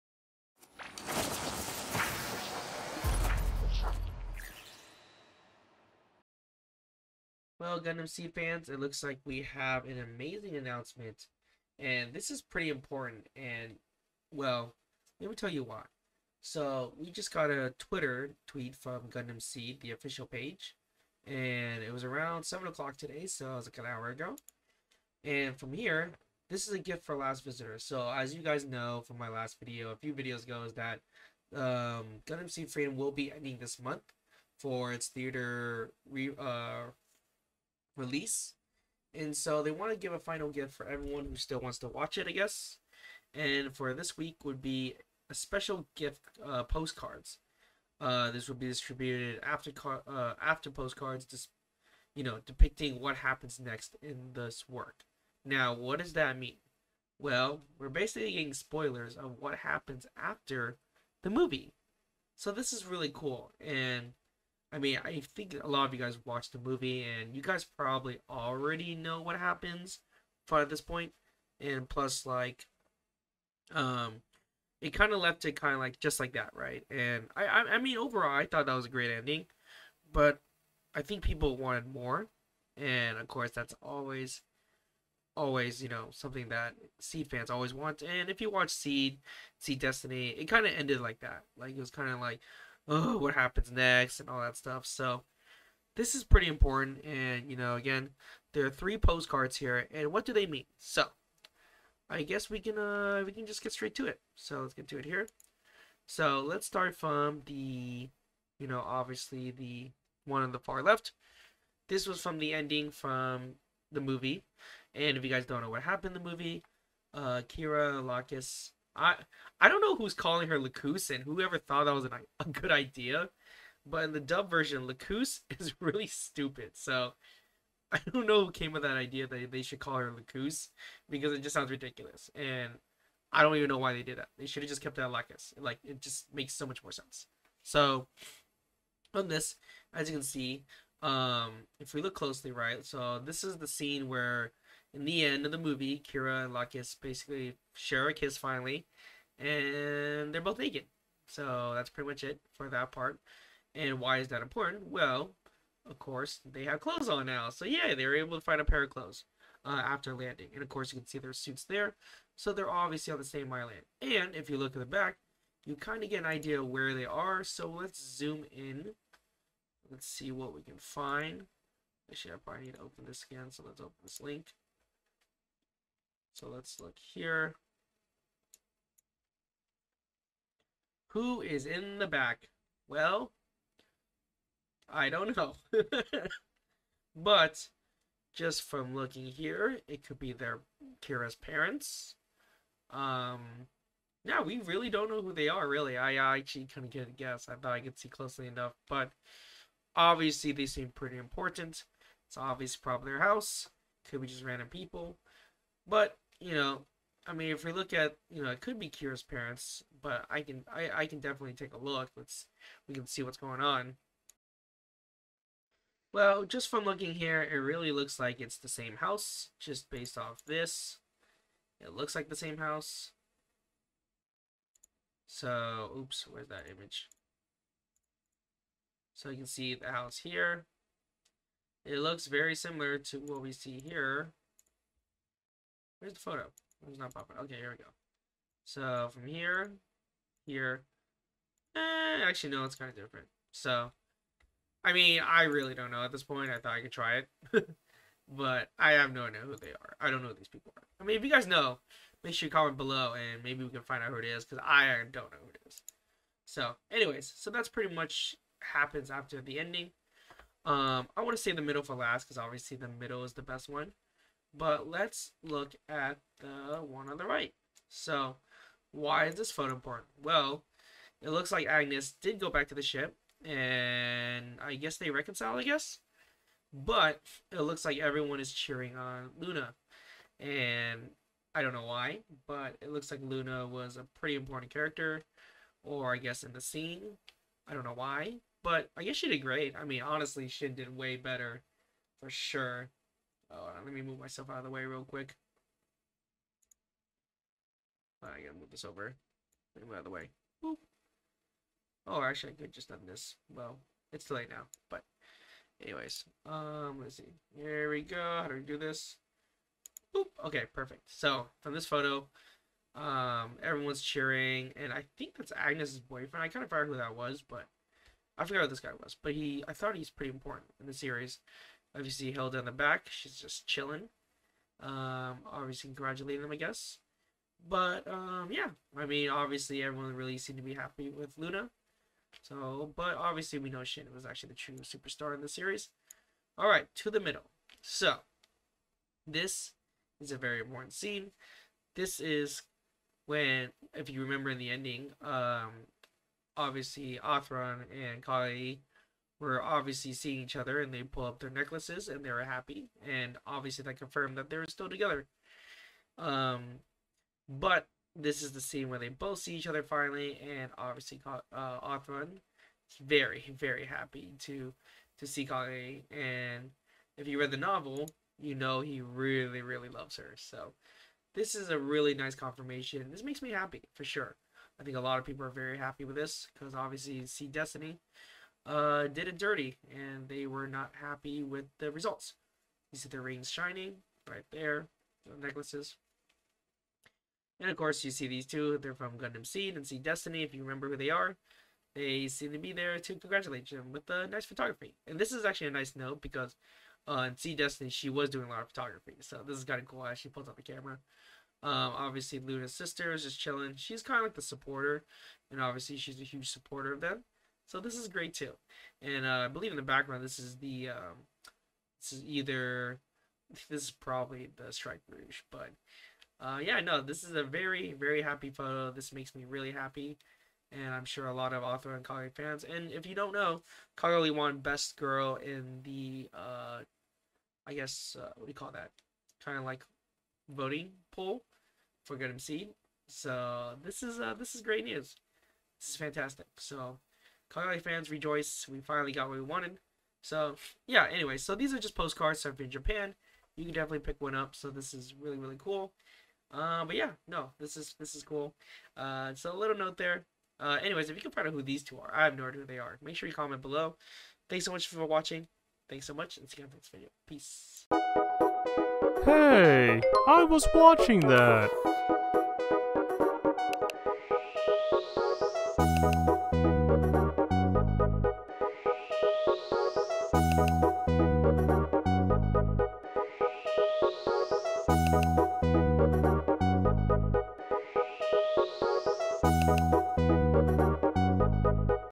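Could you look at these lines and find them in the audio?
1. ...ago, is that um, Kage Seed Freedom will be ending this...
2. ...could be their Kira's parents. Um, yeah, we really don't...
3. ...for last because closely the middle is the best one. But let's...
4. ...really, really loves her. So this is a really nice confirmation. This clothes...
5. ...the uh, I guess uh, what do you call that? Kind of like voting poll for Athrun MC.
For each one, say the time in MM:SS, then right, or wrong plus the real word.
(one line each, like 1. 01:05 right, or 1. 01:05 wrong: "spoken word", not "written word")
1. 00:30 wrong: "Gundam", not "Kage"
2. 03:10 right
3. 04:21 wrong: "obviously", not "closely"
4. 06:09 wrong: "makes", not "clothes"
5. 07:05 wrong: "Good", not "Athrun".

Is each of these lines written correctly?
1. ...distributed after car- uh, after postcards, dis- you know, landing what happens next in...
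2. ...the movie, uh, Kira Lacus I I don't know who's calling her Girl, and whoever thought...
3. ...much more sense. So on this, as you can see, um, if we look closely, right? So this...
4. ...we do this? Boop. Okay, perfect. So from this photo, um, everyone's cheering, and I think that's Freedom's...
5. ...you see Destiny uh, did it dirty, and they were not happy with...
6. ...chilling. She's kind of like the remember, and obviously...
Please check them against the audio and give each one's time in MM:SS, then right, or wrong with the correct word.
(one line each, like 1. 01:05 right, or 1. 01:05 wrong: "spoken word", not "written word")
1. 00:48 wrong: "depicting", not "landing"
2. 01:56 wrong: "Lacus", not "Girl"
3. 02:16 right
4. 05:08 wrong: "Agnes", not "Freedom"
5. 06:17 right
6. 06:43 wrong: "supporter", not "remember".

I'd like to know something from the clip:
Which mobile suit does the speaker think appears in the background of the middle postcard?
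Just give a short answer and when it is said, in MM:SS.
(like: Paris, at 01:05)
Strike Rouge, at 06:54.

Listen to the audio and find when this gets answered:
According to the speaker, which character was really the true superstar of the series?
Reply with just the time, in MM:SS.
05:33.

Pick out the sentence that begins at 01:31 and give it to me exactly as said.
Like, it was kind of like, oh, what happens next and all that stuff.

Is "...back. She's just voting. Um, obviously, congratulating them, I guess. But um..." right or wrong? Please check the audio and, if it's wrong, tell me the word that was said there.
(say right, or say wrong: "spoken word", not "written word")
wrong: "chilling", not "voting".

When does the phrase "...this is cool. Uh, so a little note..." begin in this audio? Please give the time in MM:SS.
07:27.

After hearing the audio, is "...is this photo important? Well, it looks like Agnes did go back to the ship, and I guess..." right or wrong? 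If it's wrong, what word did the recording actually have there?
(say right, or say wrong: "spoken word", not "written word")
right.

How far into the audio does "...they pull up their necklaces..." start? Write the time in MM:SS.
05:50.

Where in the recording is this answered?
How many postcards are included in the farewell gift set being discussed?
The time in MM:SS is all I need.
01:38.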